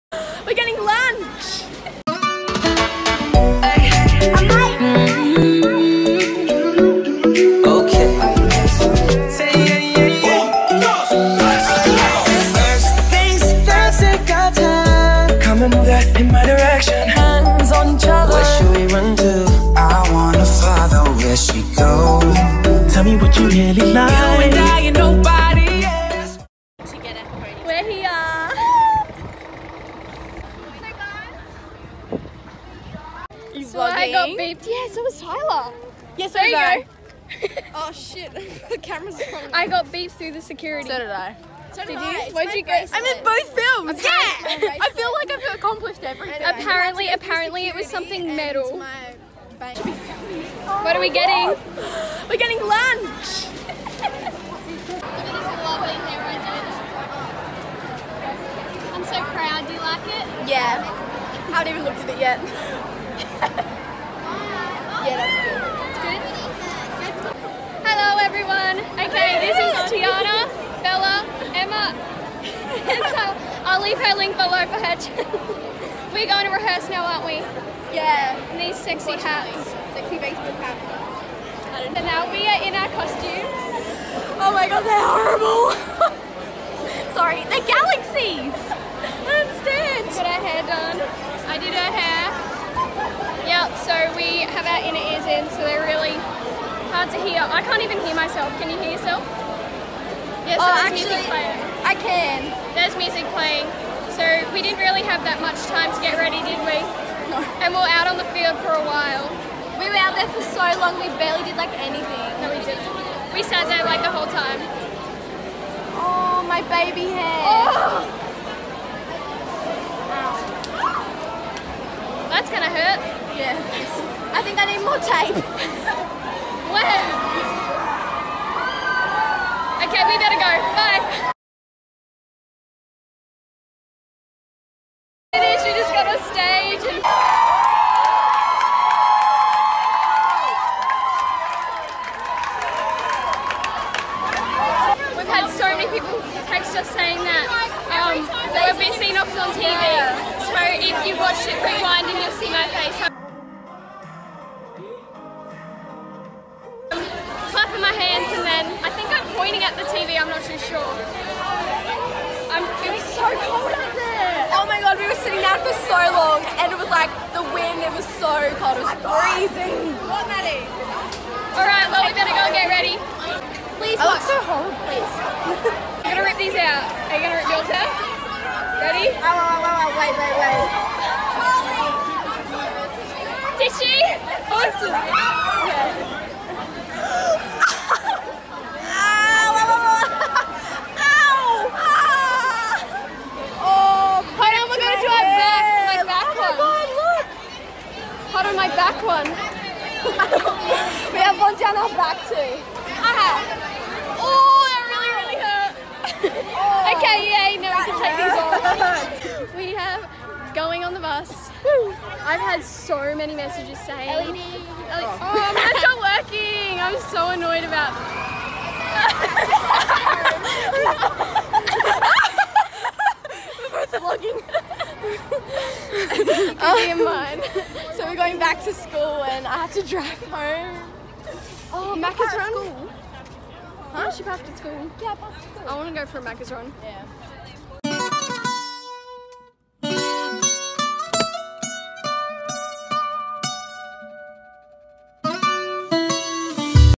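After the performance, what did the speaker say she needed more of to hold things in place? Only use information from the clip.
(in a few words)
tape.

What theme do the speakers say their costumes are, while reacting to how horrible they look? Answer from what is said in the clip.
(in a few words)
galaxies.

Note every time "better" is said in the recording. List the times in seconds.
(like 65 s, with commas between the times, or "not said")
130 s, 172 s.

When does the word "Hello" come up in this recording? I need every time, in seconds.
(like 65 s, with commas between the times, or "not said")
67 s.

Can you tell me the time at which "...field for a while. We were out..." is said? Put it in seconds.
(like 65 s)
108 s.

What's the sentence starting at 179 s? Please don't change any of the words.
Oh, oh, oh, wait, wait, wait.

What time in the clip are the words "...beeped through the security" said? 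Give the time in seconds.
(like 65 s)
39 s.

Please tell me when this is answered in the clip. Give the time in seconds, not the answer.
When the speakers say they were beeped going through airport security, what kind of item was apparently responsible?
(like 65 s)
47 s.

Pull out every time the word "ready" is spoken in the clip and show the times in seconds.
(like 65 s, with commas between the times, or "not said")
106 s, 172 s, 178 s.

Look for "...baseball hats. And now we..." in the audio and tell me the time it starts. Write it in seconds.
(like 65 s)
80 s.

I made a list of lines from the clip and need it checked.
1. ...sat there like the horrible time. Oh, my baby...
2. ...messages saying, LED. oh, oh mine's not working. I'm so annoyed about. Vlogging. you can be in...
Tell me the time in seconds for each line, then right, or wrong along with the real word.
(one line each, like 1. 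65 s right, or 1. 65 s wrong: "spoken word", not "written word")
1. 113 s wrong: "whole", not "horrible"
2. 213 s right.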